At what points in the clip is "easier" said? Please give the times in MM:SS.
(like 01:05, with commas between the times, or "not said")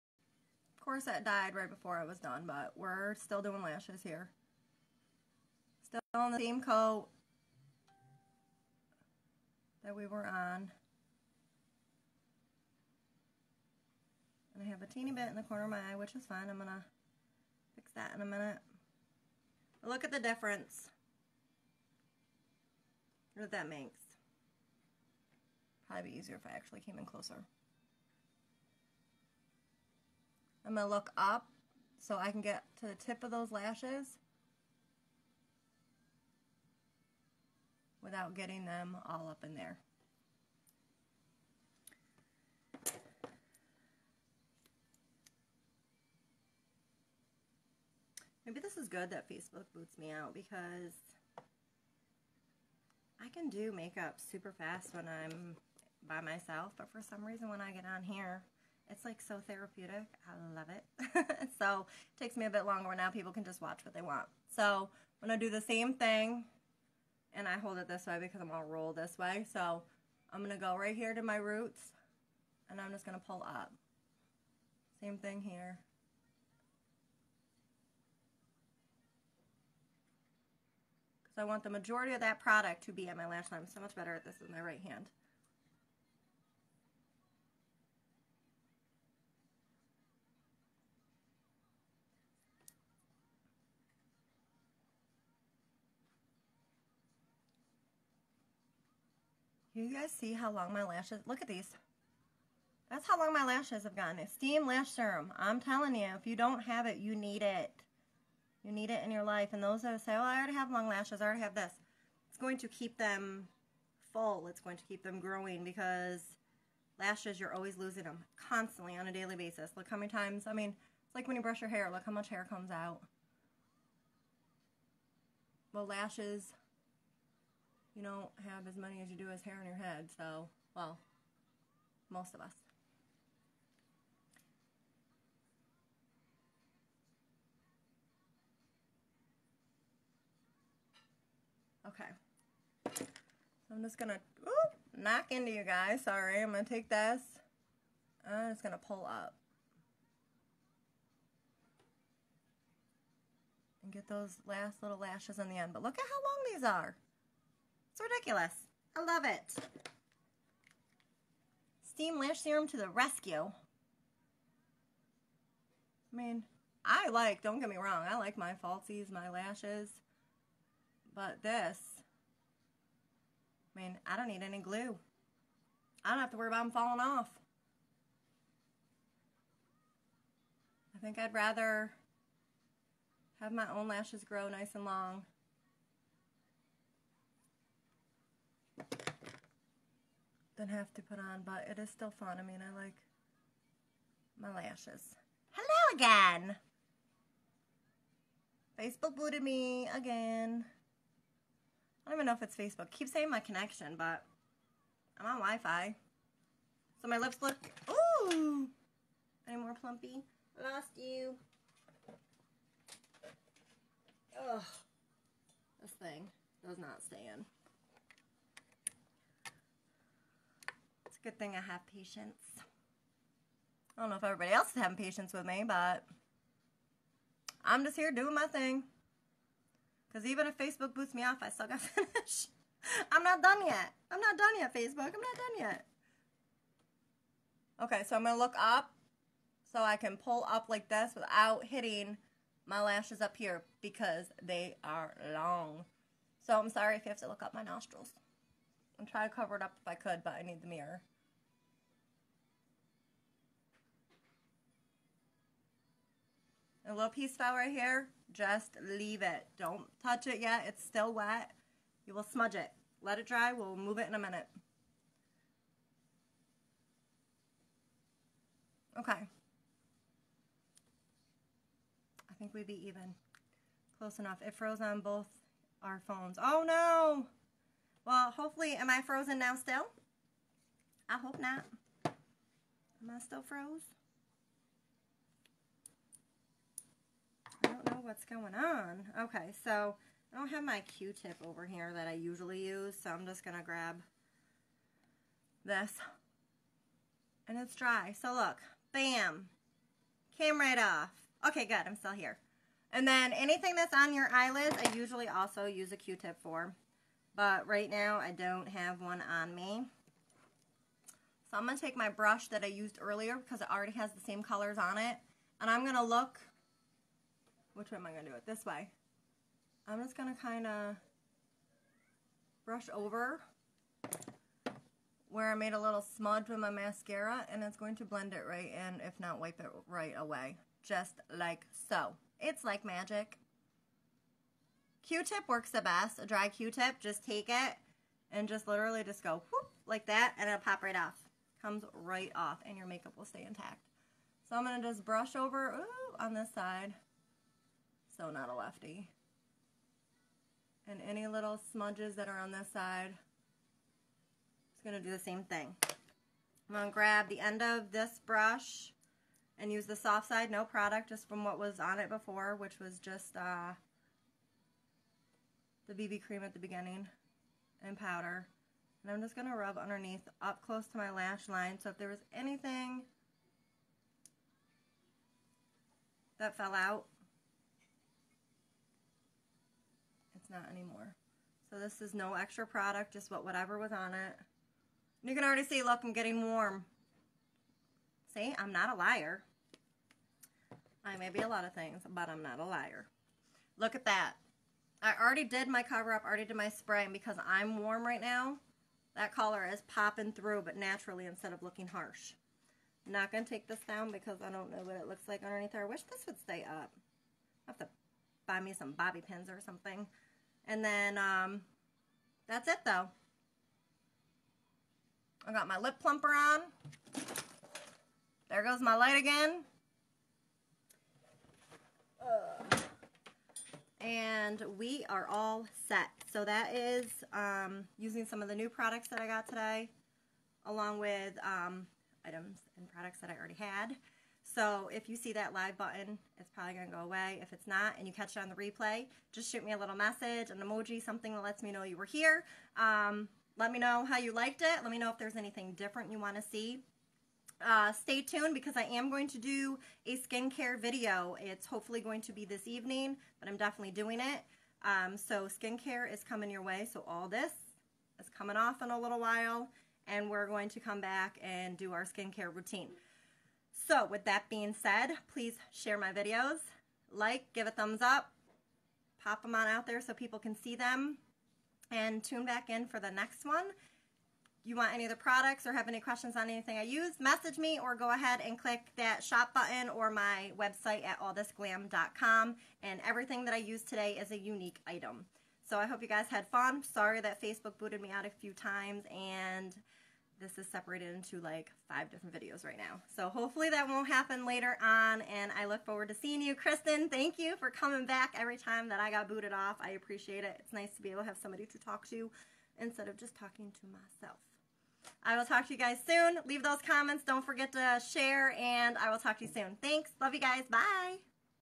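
00:26.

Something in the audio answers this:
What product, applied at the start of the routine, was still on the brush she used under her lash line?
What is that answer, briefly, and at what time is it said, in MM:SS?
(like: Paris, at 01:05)
BB cream, at 06:05.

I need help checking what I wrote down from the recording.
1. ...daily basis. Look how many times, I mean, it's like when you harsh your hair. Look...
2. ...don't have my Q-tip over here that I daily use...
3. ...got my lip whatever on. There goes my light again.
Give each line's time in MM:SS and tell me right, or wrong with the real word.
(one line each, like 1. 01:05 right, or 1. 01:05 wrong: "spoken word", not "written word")
1. 01:59 wrong: "brush", not "harsh"
2. 04:50 wrong: "usually", not "daily"
3. 06:55 wrong: "plumper", not "whatever".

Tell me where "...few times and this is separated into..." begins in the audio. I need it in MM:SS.
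08:08.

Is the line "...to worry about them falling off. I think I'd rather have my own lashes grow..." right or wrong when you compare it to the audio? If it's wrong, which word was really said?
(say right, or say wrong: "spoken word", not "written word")
right.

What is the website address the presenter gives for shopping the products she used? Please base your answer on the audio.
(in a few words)
allthisglam.com.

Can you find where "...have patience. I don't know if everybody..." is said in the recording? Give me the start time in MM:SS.
03:41.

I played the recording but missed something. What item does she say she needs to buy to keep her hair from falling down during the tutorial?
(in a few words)
bobby pins.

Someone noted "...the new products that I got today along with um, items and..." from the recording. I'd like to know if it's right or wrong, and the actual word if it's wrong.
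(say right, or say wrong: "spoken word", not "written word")
right.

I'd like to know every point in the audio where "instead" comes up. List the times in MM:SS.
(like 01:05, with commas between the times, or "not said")
06:41, 08:22.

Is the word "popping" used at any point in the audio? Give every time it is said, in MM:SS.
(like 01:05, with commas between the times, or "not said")
06:39.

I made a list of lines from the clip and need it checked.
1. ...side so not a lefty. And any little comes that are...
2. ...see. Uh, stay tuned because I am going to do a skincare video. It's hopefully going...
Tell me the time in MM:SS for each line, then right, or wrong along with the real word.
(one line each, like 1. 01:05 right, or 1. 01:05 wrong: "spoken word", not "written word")
1. 05:46 wrong: "smudges", not "comes"
2. 07:26 right.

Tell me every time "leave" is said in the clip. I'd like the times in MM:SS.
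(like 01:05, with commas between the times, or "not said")
04:18, 08:26.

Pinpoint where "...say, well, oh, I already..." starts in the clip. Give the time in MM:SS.
01:50.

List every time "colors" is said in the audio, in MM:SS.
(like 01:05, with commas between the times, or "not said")
05:14, 06:39.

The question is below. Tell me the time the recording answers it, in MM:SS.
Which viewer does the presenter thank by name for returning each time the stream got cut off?
08:16.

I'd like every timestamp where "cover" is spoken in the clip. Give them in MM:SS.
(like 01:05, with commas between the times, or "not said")
04:09, 06:35.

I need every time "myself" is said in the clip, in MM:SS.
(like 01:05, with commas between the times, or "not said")
00:56, 08:23.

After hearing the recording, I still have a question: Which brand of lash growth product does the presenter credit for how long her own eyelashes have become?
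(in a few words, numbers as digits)
Esteem Lash Serum.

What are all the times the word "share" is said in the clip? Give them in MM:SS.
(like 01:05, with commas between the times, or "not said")
07:45, 08:28.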